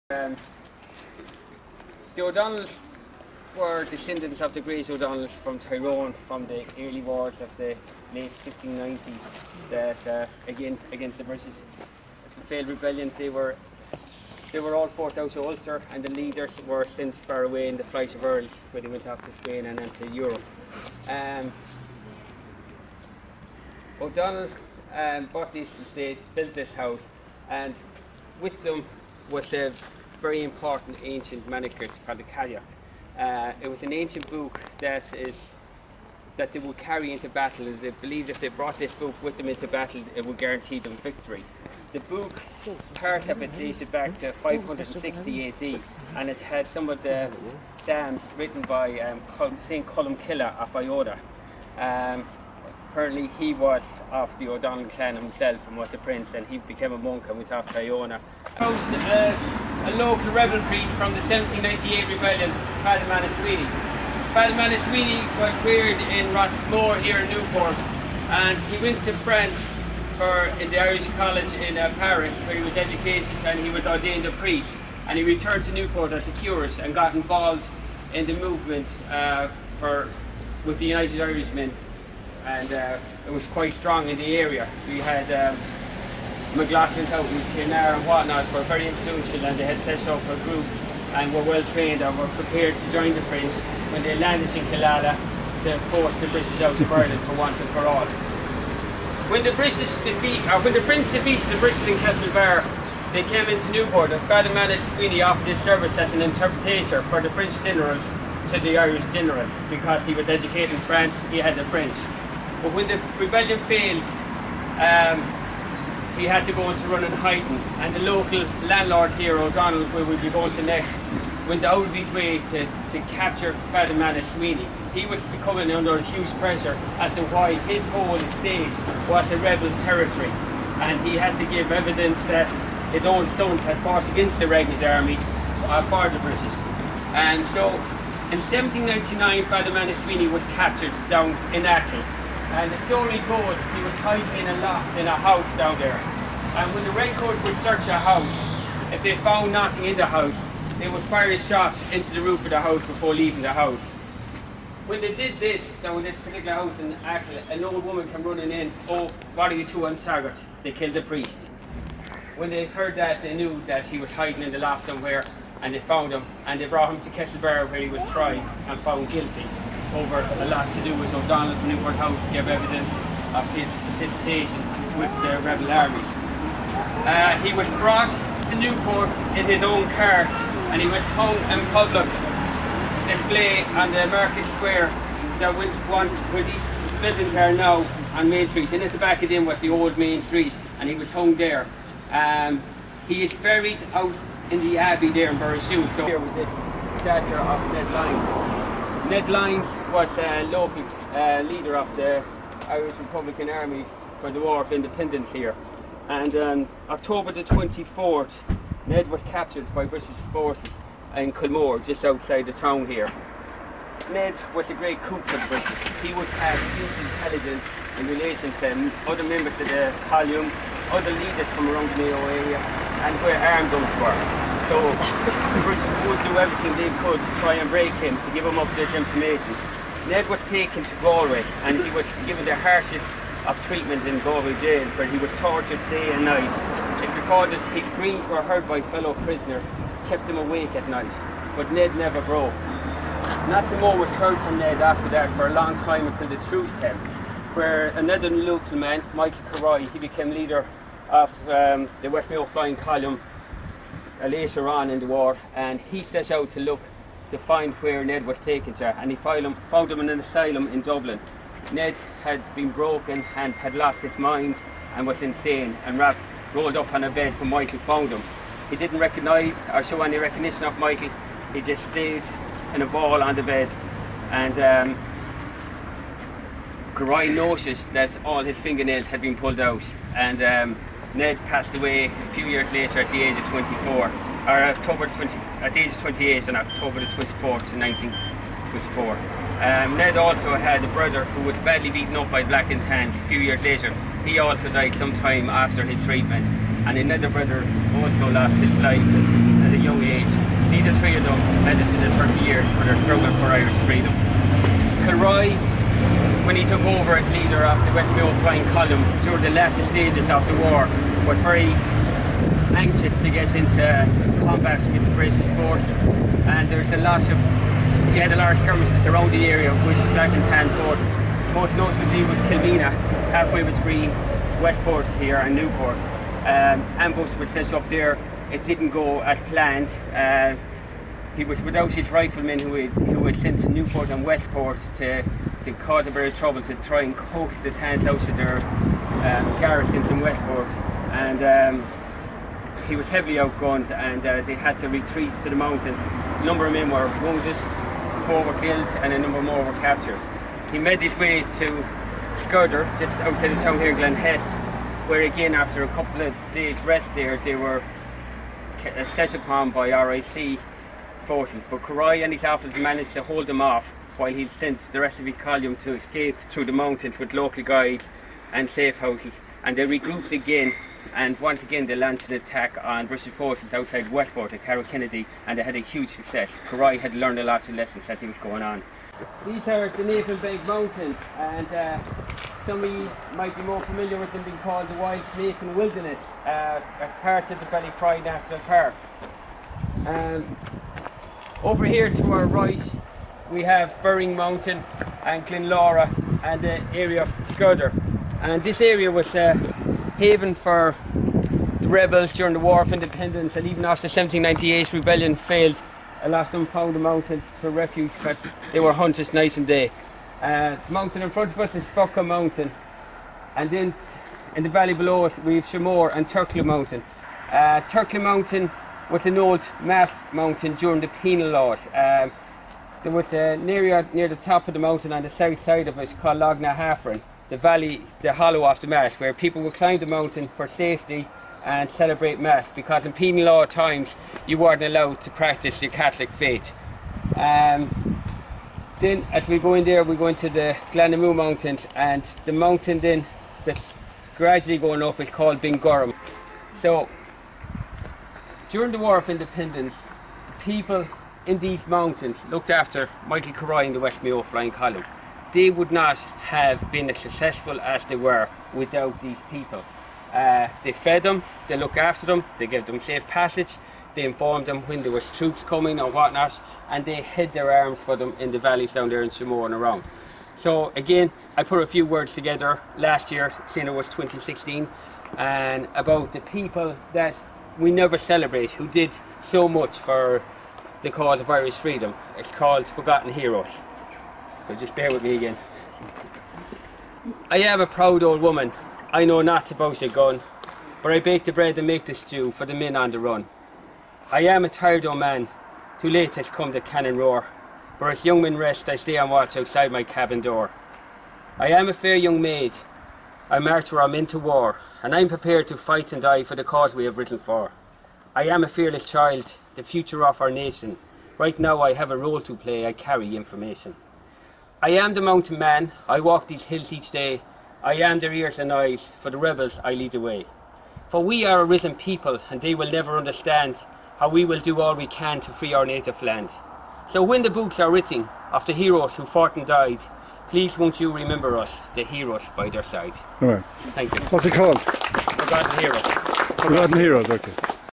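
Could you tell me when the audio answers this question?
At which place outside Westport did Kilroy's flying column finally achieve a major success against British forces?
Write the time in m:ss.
6:14.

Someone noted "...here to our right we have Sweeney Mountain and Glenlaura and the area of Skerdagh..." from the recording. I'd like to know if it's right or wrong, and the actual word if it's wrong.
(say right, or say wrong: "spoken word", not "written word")
wrong: "Burring", not "Sweeney".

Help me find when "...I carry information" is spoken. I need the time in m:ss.
8:32.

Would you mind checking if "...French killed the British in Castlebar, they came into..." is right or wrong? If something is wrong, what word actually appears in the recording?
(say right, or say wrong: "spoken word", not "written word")
wrong: "defeated", not "killed".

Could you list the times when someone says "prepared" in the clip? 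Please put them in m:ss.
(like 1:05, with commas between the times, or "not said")
1:32, 8:25.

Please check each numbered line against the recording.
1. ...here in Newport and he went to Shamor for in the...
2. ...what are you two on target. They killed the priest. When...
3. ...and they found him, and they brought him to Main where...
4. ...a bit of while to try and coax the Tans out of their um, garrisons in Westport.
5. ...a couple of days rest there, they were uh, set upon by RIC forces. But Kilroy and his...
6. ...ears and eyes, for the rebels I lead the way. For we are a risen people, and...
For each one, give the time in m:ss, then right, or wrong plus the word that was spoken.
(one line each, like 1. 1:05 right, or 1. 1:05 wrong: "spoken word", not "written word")
1. 1:07 wrong: "France", not "Shamor"
2. 2:39 right
3. 2:45 wrong: "Castlebar", not "Main"
4. 5:36 wrong: "trouble", not "while"
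5. 5:55 right
6. 8:38 right.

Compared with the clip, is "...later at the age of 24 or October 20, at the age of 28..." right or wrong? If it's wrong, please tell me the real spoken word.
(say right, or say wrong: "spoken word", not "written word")
right.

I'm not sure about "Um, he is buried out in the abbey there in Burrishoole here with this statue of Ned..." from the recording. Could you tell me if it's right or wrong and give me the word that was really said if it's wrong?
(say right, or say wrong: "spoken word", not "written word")
right.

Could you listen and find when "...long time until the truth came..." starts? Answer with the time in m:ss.
4:05.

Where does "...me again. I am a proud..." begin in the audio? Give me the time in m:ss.
8:05.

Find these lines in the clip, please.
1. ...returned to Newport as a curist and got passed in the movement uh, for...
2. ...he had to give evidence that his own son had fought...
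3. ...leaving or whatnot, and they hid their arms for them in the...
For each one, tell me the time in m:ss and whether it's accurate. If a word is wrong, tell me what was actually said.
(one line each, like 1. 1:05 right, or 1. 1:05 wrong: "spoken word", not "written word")
1. 1:15 wrong: "involved", not "passed"
2. 2:11 right
3. 7:45 wrong: "coming", not "leaving".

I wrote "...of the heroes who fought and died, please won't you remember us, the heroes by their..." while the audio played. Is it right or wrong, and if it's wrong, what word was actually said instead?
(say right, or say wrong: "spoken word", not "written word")
right.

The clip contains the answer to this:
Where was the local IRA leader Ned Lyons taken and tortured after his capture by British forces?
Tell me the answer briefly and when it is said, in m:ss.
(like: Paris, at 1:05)
Galway jail, at 3:54.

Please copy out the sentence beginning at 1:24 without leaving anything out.
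We had um, McLaughlin's out in Kilnara and whatnot.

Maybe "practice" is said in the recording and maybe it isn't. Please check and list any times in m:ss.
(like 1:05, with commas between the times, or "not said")
7:15.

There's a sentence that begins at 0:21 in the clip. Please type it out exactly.
Um, O'Donnell um, bought these estates, built this house and with them was a uh, very important ancient manuscript called the Cathach.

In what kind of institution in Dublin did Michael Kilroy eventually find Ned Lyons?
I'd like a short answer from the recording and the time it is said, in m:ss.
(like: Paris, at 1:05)
An asylum, at 4:20.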